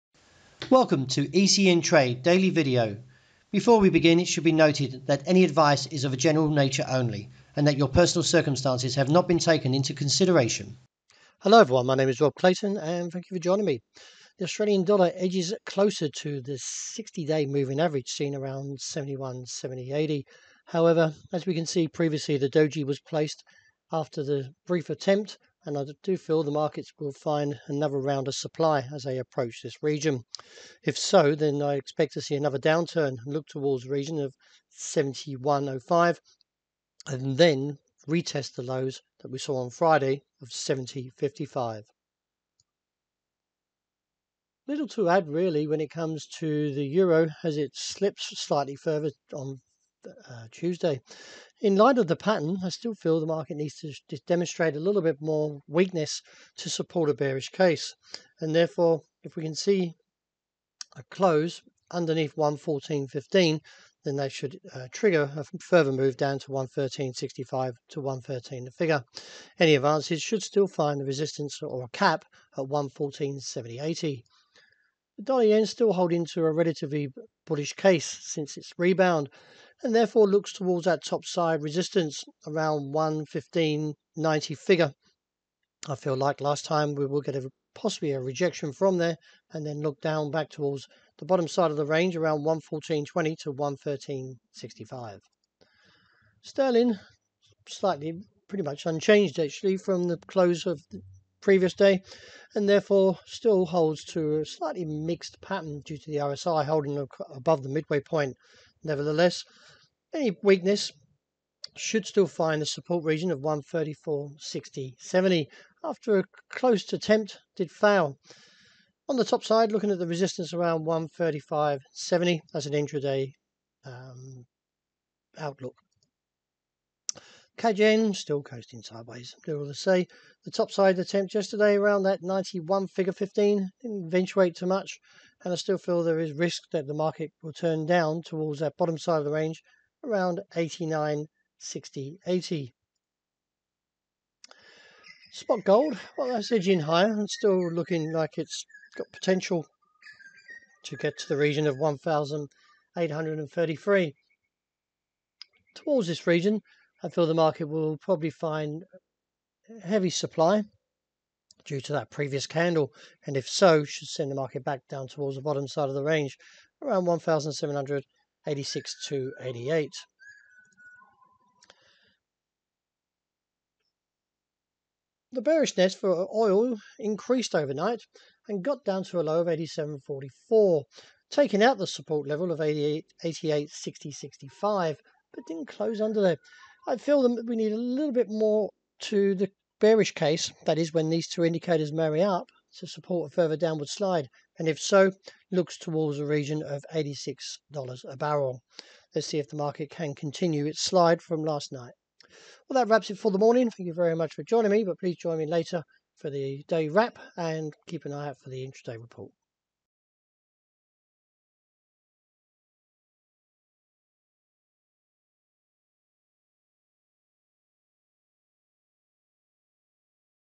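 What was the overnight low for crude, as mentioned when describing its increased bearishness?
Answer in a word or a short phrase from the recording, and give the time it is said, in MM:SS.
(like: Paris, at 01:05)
87.44, at 02:59.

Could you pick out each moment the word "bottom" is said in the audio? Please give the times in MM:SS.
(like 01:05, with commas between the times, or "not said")
01:31, 02:18, 02:45.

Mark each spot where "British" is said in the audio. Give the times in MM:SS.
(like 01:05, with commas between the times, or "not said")
not said.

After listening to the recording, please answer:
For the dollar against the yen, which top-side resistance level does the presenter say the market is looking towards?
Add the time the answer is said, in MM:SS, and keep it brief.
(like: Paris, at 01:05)
115.90, at 01:22.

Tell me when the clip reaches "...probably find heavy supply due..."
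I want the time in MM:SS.
02:37.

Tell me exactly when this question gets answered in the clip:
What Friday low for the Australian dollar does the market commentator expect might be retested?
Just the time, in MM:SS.
00:40.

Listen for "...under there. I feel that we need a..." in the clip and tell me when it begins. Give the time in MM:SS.
03:06.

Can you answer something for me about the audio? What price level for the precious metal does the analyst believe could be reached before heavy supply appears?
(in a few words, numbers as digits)
1,833.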